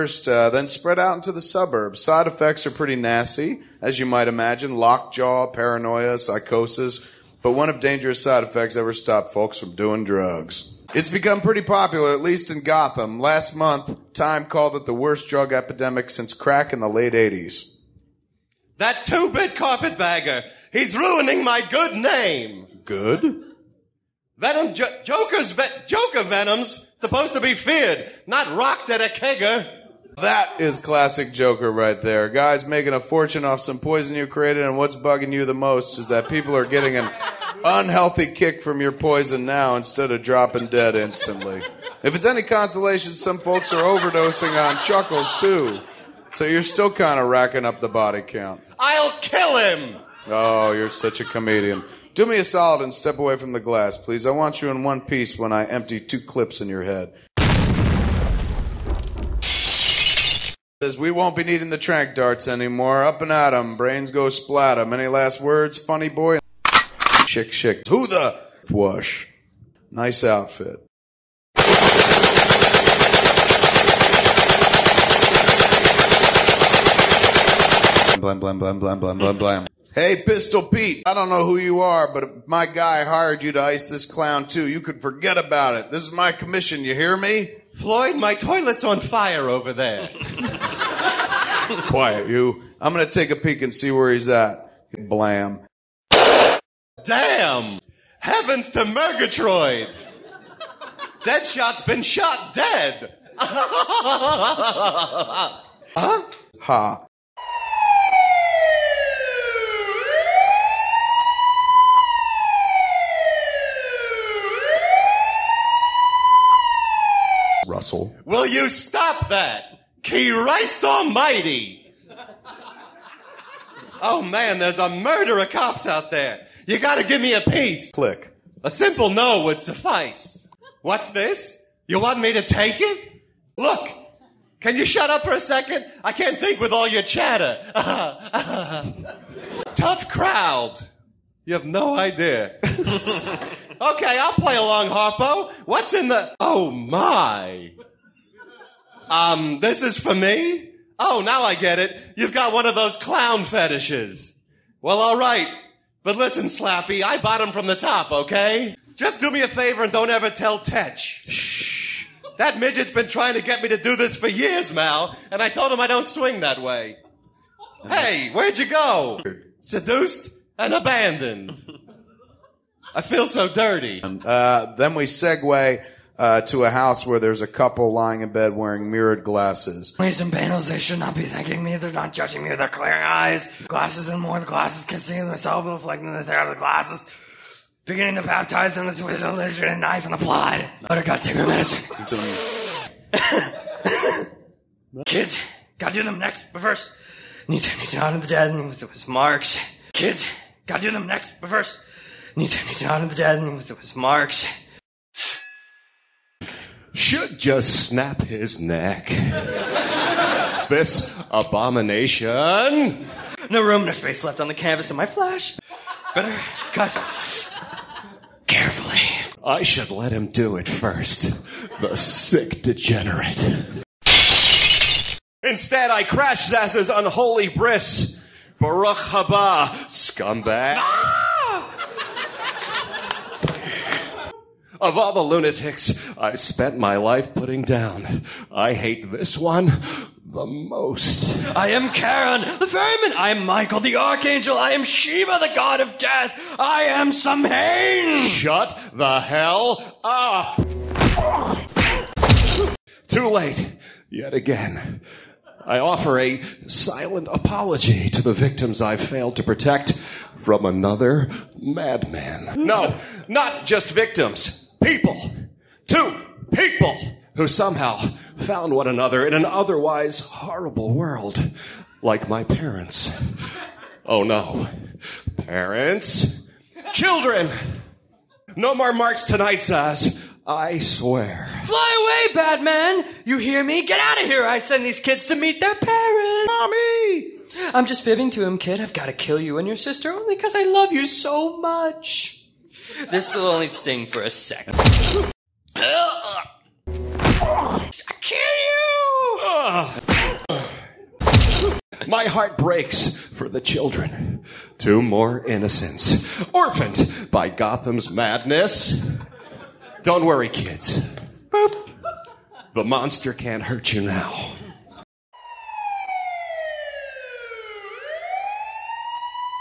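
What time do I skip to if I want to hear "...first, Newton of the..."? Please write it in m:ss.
3:21.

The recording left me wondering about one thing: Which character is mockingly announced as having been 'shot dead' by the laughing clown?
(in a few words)
Deadshot.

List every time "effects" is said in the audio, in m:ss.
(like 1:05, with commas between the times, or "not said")
0:02, 0:08.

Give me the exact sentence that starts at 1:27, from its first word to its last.
Floyd, my toilet's on fire over there.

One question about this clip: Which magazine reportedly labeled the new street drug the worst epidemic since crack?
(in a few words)
Time.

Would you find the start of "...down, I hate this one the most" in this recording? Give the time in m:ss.
3:57.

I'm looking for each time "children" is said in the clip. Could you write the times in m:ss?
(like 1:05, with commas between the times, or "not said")
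4:36, 5:03.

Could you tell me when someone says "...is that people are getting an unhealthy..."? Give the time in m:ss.
0:35.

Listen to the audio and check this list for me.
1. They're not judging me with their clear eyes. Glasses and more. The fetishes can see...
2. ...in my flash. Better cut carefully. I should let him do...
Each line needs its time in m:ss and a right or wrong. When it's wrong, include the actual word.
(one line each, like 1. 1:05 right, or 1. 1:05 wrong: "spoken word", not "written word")
1. 3:01 wrong: "glasses", not "fetishes"
2. 3:34 right.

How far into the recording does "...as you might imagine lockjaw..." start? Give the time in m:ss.
0:03.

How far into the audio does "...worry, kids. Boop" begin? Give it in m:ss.
5:10.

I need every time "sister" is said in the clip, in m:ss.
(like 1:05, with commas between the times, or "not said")
4:49.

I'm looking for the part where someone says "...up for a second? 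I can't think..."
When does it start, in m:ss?
2:15.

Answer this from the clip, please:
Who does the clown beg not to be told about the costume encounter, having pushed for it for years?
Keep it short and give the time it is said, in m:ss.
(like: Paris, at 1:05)
Tetch, at 2:40.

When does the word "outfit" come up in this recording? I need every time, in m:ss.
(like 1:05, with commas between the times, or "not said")
1:10.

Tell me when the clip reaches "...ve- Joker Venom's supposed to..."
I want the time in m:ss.
0:25.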